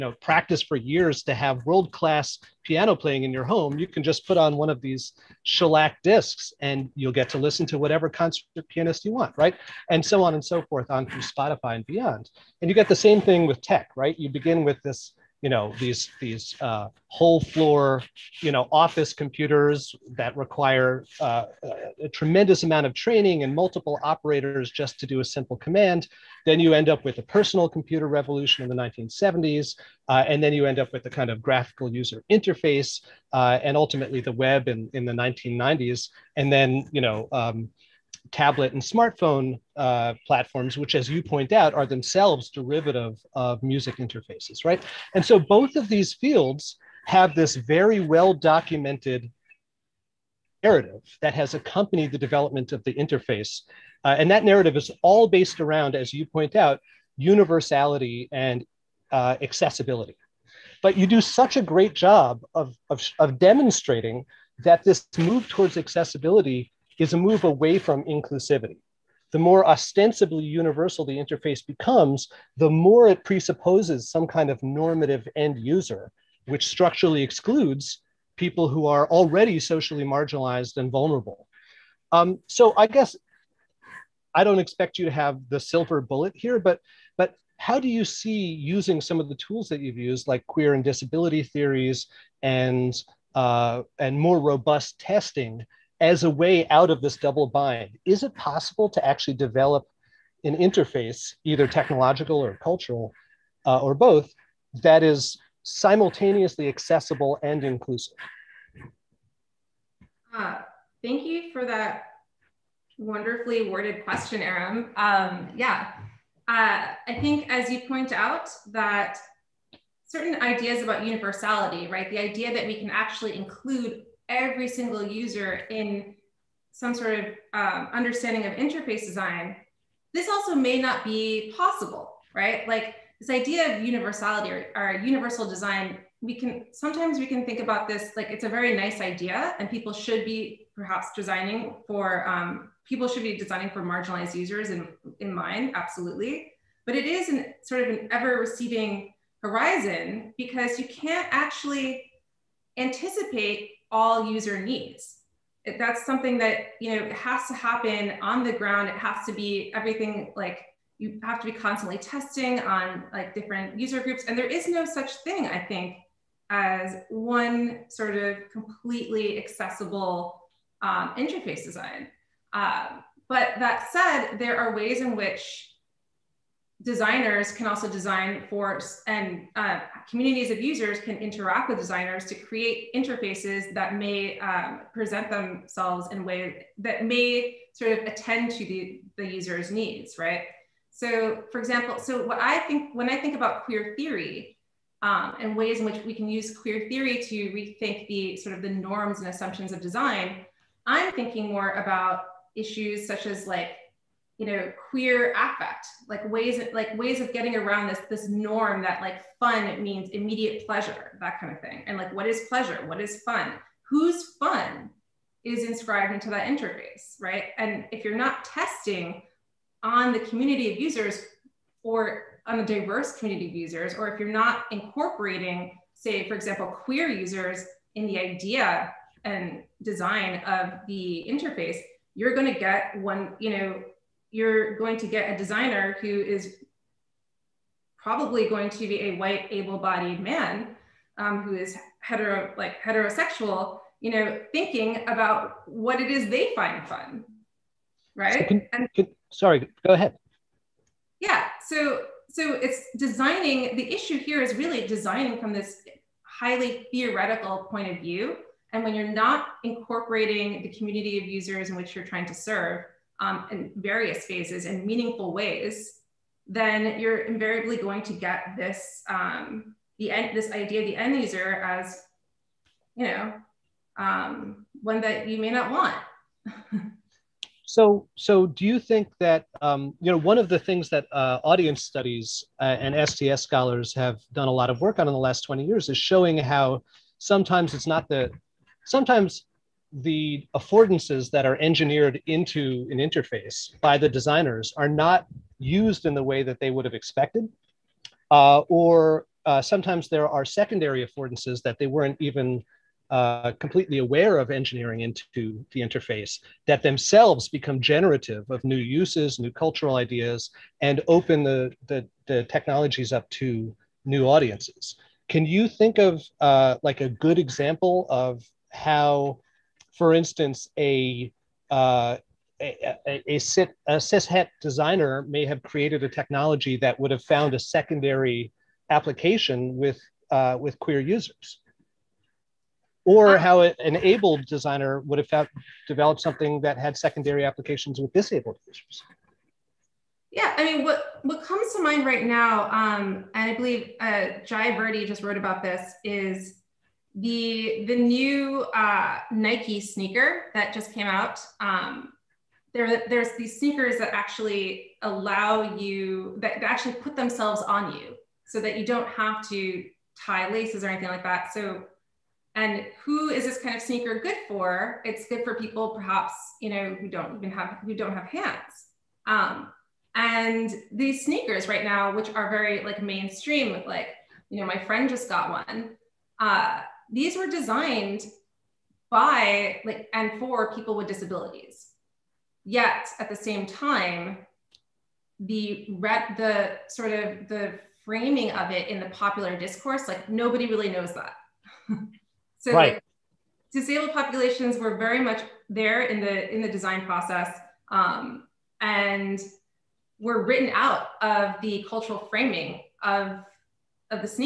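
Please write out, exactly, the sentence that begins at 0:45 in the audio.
And so both of these fields have this very well documented narrative that has accompanied the development of the interface.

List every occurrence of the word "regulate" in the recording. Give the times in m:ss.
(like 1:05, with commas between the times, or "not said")
not said.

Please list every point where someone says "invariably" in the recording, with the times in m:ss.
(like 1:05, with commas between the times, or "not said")
4:27.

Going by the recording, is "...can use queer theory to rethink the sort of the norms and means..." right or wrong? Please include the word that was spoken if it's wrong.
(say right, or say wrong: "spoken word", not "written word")
wrong: "assumptions", not "means".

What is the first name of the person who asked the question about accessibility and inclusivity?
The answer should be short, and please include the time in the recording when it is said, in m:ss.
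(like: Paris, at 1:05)
Aram, at 1:54.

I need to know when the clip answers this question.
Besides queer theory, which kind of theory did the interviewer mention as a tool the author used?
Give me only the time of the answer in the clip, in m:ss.
1:30.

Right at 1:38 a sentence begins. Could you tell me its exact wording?
Is it possible to actually develop an interface, either technological or cultural uh, or both, that is simultaneously accessible and inclusive?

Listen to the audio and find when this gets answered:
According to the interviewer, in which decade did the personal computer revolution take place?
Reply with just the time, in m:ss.
0:28.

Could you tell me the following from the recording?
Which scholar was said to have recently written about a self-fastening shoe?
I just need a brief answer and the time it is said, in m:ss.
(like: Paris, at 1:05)
Jai Virdi, at 5:44.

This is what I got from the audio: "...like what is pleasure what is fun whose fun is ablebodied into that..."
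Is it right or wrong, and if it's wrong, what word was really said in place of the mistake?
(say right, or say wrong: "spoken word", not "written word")
wrong: "inscribed", not "ablebodied".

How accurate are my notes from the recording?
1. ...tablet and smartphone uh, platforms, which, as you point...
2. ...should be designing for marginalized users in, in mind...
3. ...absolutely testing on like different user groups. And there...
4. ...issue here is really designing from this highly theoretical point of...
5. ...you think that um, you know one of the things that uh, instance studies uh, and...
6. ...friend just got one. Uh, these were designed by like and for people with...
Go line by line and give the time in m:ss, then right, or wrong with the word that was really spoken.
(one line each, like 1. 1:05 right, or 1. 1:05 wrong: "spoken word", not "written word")
1. 0:38 right
2. 2:23 right
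3. 2:41 wrong: "constantly", not "absolutely"
4. 4:13 right
5. 4:38 wrong: "audience", not "instance"
6. 6:14 right.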